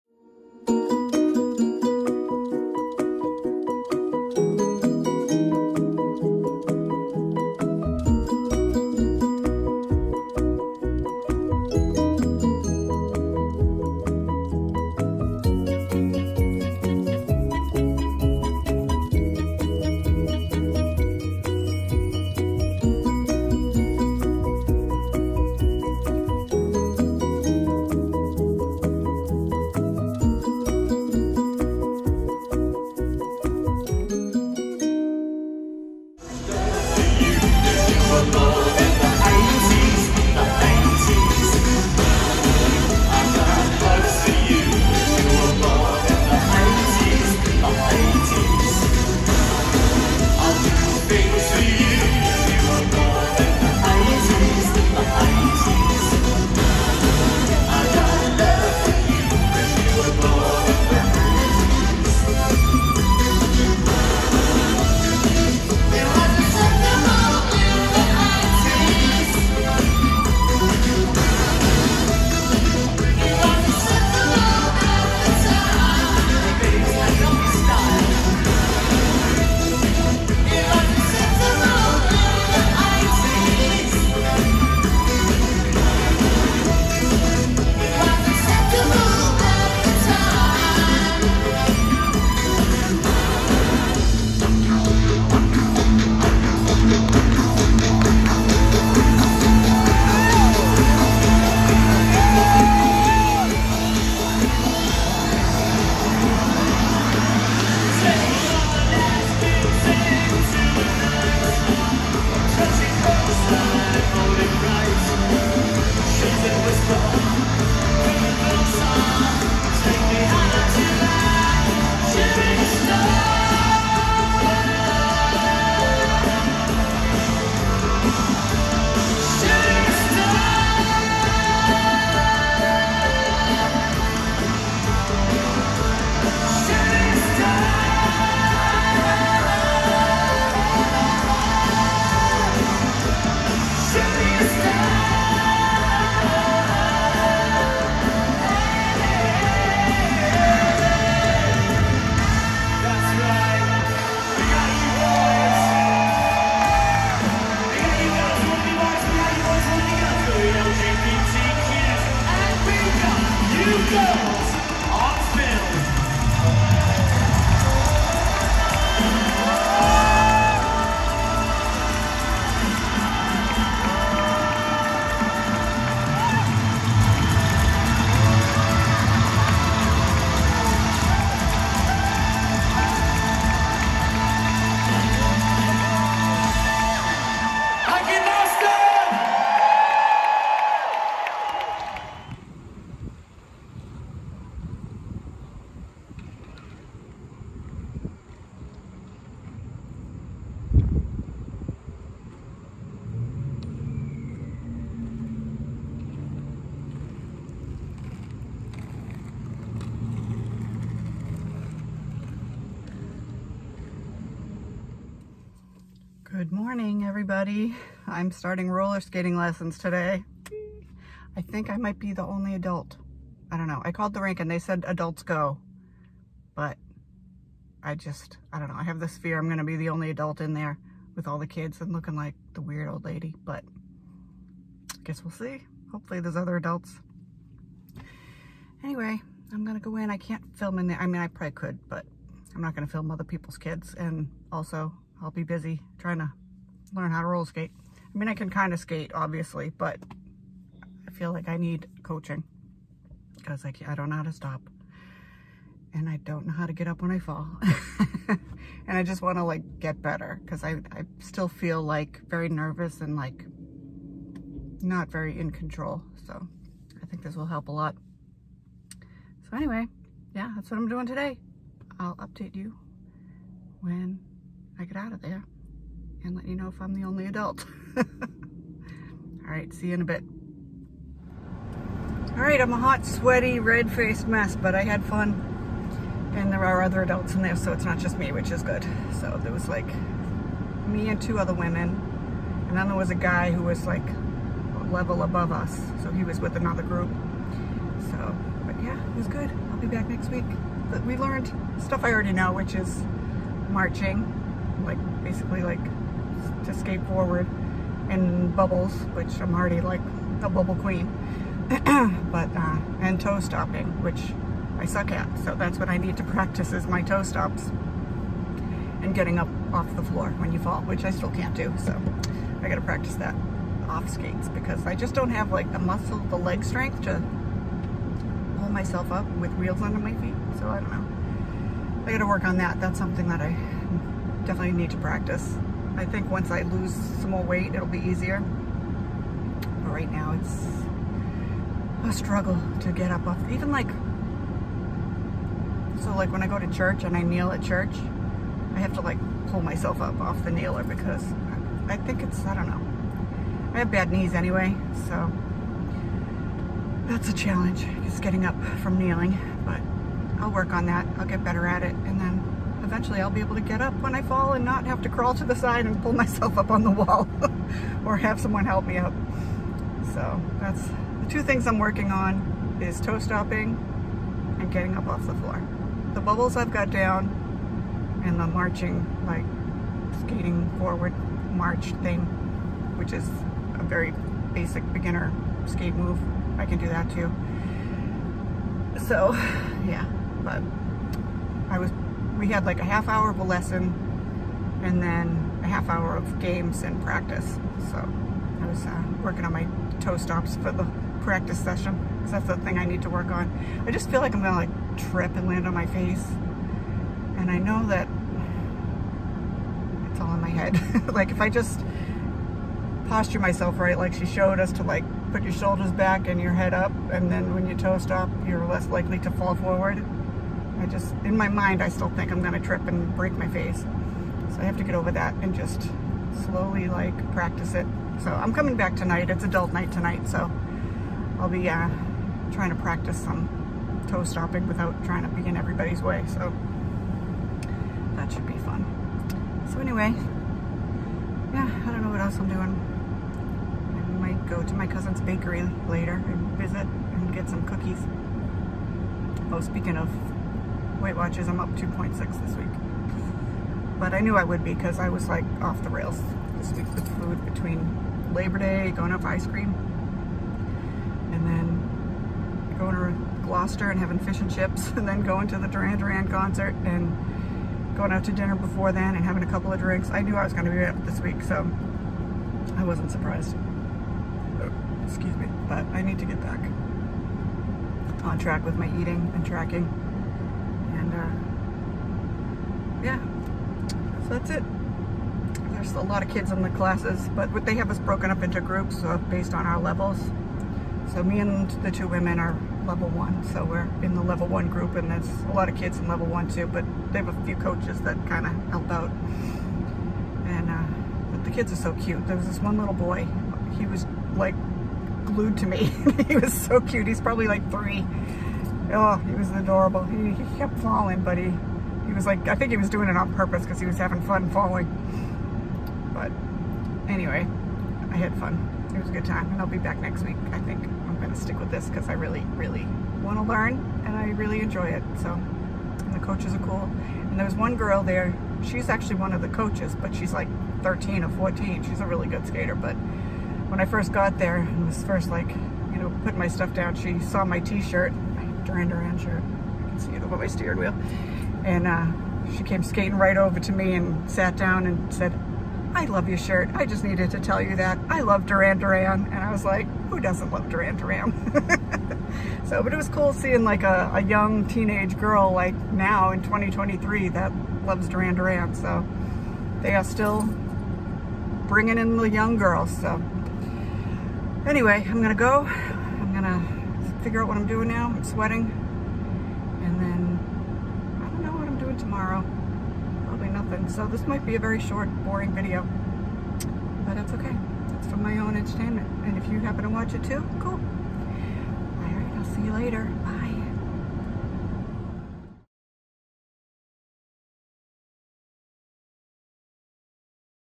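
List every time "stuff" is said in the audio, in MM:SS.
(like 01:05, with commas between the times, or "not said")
05:01, 08:56.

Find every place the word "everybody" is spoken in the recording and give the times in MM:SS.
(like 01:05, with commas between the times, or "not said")
03:37, 07:15.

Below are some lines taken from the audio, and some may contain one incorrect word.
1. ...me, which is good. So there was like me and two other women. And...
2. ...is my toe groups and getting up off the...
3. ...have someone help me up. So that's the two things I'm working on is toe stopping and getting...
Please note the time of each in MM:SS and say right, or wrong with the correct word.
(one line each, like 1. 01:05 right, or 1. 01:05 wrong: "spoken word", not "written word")
1. 04:48 right
2. 05:16 wrong: "stops", not "groups"
3. 06:08 right.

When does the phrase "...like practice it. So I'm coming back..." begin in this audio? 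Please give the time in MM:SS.
07:06.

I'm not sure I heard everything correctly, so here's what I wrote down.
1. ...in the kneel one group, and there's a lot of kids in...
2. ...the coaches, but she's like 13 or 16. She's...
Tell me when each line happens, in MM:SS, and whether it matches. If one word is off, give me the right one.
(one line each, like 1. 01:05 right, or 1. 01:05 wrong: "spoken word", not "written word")
1. 08:14 wrong: "level", not "kneel"
2. 08:49 wrong: "14", not "16".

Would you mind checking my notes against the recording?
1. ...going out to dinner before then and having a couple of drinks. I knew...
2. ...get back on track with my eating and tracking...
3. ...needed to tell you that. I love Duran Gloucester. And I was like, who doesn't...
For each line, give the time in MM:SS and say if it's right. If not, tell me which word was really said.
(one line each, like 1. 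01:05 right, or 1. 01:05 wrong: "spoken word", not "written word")
1. 07:47 right
2. 07:56 right
3. 09:07 wrong: "Duran", not "Gloucester".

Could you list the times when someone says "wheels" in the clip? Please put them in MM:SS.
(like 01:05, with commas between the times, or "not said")
05:29, 09:00.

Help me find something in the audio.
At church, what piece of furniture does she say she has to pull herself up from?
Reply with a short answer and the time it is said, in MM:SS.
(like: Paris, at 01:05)
The kneeler, at 05:50.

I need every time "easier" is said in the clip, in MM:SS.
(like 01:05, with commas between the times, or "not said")
05:37.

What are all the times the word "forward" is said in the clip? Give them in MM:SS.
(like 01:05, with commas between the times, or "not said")
05:07, 06:20, 06:59.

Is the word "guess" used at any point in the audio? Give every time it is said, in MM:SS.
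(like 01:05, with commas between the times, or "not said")
03:55.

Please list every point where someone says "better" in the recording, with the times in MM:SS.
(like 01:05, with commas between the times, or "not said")
04:20, 06:01.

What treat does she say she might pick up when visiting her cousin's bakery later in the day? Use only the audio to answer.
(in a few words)
Cookies.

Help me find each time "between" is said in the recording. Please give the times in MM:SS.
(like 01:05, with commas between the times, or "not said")
07:37.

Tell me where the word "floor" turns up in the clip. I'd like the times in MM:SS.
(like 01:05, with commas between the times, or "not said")
05:20, 06:15.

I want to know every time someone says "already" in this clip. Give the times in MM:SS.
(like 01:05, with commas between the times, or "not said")
05:02, 05:09.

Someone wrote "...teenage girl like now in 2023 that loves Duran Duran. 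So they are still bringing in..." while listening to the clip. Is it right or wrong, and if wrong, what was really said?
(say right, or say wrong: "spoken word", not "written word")
right.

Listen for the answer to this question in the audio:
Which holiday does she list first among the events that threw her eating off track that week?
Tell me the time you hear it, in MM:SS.
07:38.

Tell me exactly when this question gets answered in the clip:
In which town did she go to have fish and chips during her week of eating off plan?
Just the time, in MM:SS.
07:43.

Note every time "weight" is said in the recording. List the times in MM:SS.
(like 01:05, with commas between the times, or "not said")
05:37, 07:31.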